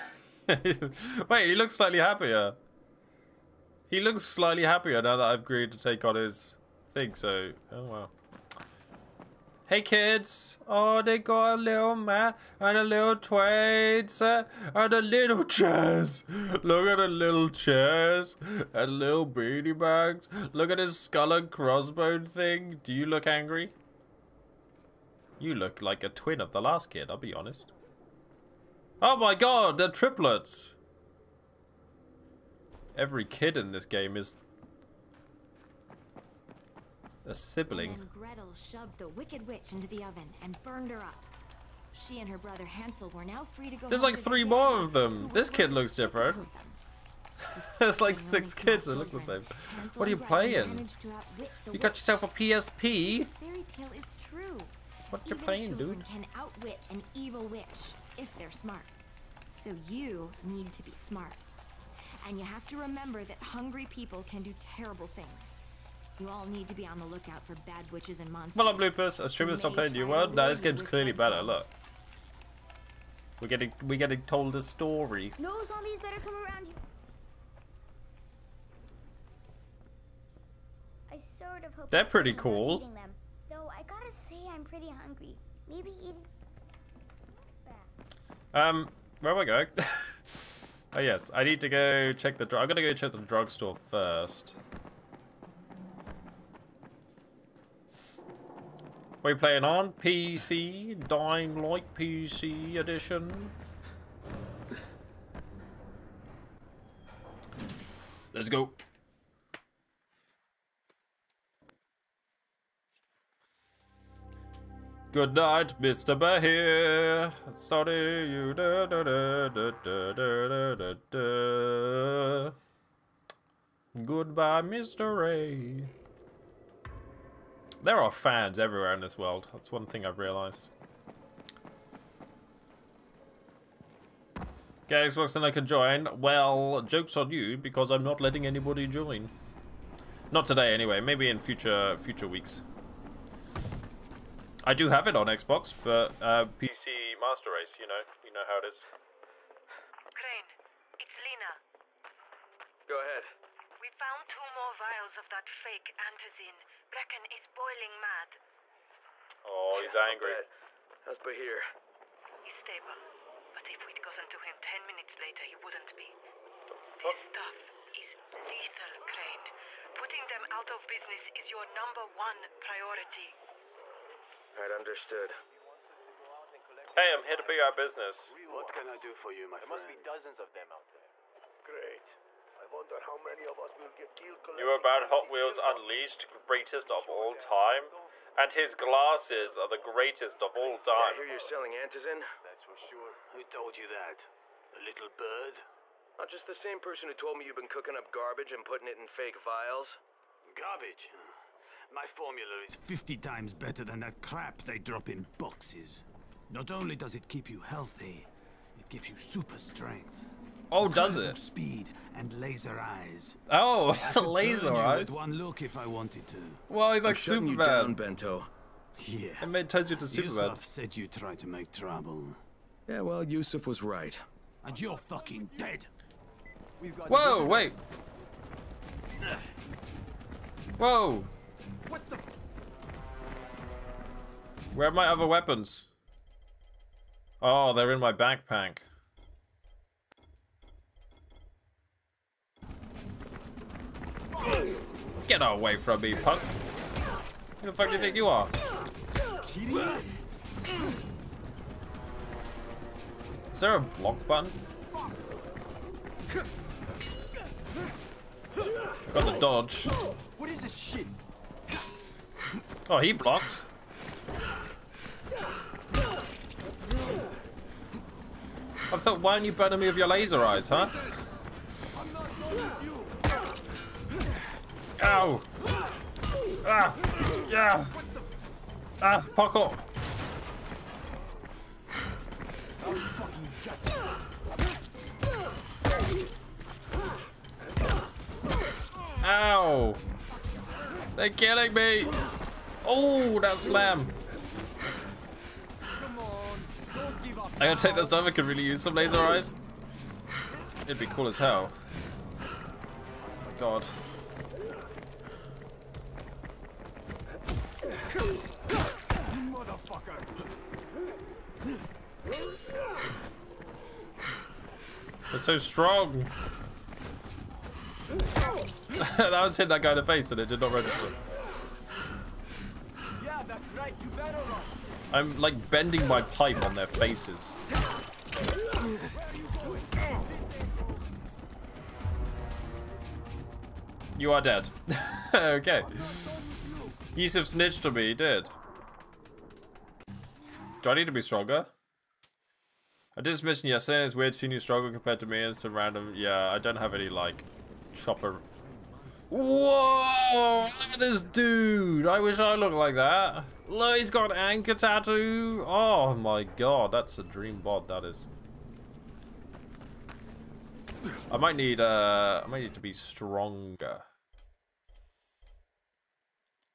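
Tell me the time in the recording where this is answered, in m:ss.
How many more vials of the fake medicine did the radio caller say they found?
2:34.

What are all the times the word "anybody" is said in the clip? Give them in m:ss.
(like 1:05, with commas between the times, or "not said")
2:18.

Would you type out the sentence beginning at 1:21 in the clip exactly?
I sort of hope they're pretty cool.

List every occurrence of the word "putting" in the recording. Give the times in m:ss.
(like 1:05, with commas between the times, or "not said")
2:49, 3:18.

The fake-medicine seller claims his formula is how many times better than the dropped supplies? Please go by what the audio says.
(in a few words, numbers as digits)
50.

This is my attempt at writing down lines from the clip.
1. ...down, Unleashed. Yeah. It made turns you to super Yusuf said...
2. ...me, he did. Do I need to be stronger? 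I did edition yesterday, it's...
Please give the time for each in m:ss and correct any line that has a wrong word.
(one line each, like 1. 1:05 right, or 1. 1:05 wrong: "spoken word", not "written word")
1. 3:37 wrong: "Bento", not "Unleashed"
2. 5:37 wrong: "mention", not "edition".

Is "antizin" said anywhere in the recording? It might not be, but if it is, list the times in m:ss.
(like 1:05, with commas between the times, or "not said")
2:35, 3:11.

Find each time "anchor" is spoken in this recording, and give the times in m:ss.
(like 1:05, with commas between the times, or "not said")
5:54.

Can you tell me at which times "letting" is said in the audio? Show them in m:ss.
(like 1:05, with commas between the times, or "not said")
2:18.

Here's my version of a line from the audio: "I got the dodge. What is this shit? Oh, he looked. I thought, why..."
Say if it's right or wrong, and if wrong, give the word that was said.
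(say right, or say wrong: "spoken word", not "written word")
wrong: "blocked", not "looked".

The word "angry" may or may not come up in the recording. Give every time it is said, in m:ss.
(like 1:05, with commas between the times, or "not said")
0:23, 2:39.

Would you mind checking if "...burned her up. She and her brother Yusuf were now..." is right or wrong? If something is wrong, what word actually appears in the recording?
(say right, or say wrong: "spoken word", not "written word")
wrong: "Hansel", not "Yusuf".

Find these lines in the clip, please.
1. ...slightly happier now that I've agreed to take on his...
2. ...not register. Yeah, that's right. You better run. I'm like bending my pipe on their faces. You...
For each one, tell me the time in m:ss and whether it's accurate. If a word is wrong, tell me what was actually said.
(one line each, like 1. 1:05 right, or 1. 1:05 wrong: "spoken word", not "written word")
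1. 0:04 right
2. 5:20 right.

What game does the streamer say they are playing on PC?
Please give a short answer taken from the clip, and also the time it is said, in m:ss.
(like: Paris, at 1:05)
Dying Light, at 1:41.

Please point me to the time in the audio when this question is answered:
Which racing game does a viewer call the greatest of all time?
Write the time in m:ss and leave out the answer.
3:05.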